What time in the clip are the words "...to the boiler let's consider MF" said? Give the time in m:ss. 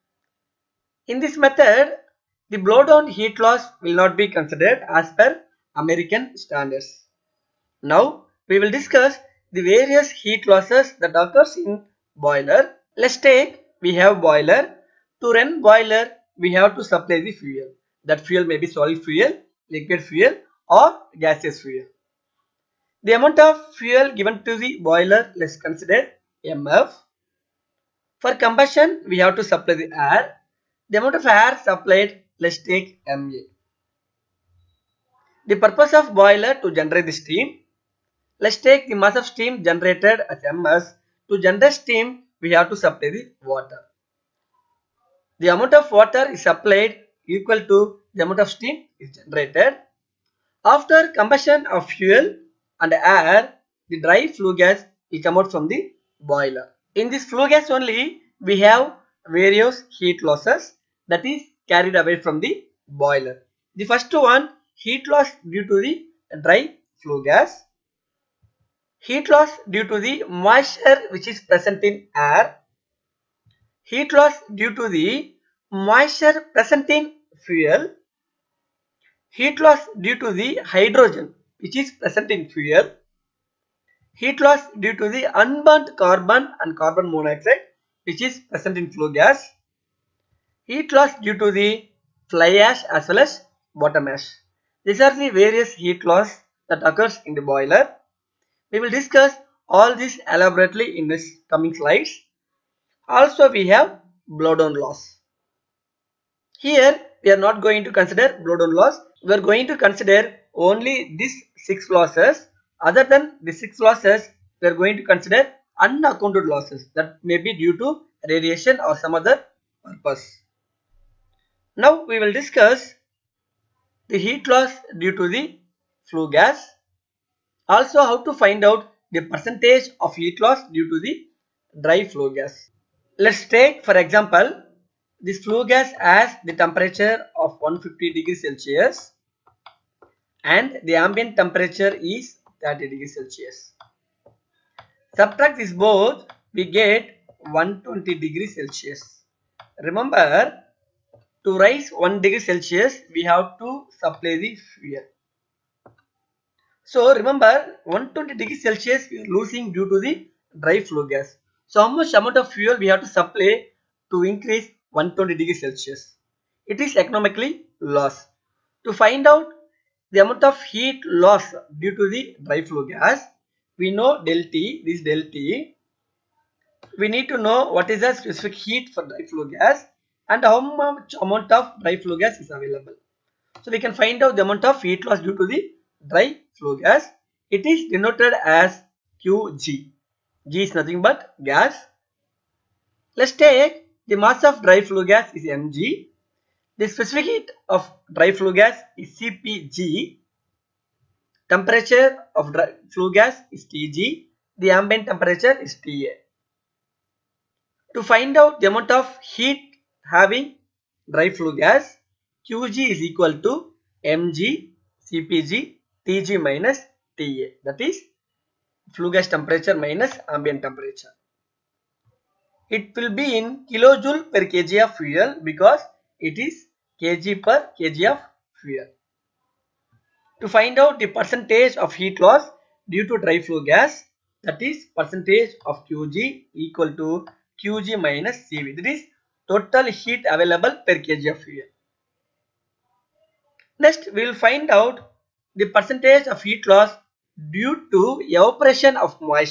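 0:24.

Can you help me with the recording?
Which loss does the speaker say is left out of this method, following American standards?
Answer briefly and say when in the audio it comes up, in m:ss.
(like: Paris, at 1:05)
Blowdown heat loss, at 0:02.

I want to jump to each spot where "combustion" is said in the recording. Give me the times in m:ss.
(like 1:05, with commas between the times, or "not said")
0:28, 0:51.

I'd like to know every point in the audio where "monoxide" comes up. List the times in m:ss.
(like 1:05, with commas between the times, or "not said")
1:27.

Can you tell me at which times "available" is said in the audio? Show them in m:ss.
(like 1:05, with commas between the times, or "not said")
3:02, 4:00.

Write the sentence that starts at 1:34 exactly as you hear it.
These are the various heat loss that occurs in the boiler.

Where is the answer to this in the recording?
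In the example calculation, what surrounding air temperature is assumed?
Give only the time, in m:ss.
2:22.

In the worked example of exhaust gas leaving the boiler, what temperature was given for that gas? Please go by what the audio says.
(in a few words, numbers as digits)
150 degrees Celsius.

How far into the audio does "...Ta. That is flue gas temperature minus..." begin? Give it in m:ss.
3:37.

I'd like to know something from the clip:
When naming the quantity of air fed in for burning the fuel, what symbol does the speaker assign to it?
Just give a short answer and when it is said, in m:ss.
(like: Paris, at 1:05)
MA, at 0:33.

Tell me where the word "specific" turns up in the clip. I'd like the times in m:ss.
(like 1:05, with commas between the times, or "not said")
2:58, 3:16.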